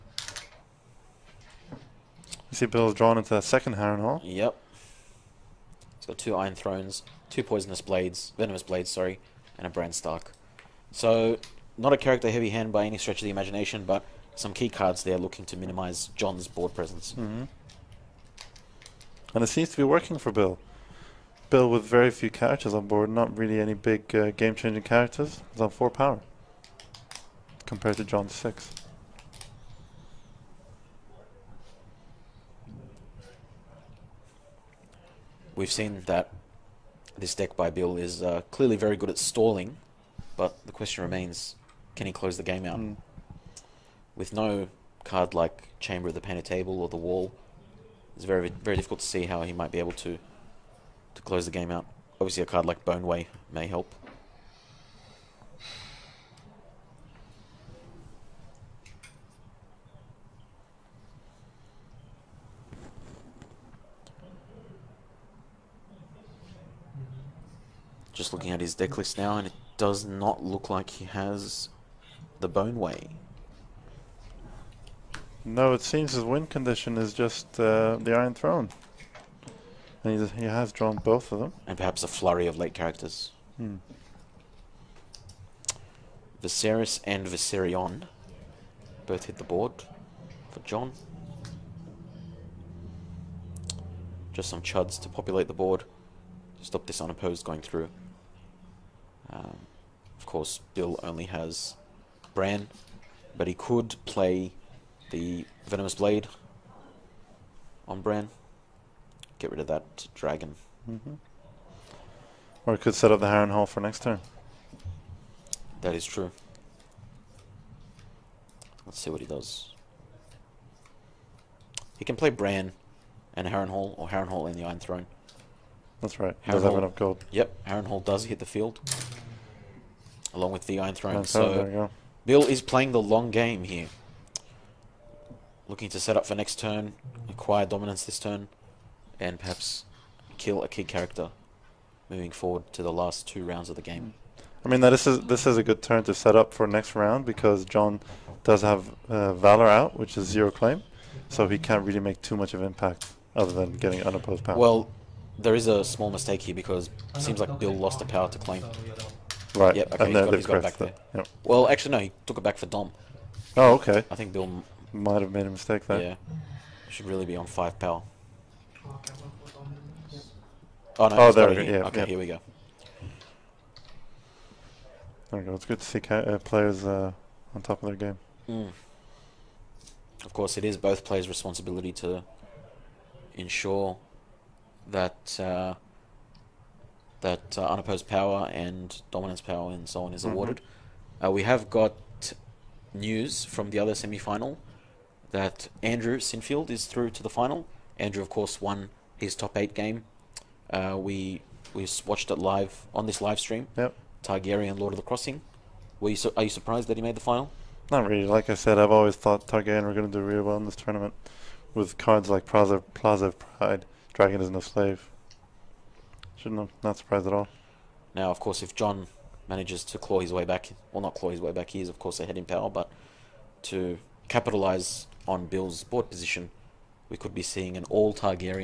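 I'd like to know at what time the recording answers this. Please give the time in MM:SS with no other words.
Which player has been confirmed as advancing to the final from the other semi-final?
03:15.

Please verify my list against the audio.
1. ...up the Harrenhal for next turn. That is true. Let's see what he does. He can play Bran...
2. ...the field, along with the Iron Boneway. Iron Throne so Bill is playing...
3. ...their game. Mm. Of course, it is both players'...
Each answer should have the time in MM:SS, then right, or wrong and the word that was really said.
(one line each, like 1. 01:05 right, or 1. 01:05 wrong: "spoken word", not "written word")
1. 01:53 right
2. 02:08 wrong: "Throne", not "Boneway"
3. 02:57 right.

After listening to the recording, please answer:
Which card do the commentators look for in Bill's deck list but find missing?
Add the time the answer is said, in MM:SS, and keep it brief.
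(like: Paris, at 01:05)
Bone Way, at 01:12.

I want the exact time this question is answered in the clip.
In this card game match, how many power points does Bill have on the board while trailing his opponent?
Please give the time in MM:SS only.
00:25.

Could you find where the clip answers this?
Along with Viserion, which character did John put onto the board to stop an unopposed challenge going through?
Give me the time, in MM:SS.
01:26.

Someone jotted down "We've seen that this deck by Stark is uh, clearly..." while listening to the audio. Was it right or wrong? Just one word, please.
wrong.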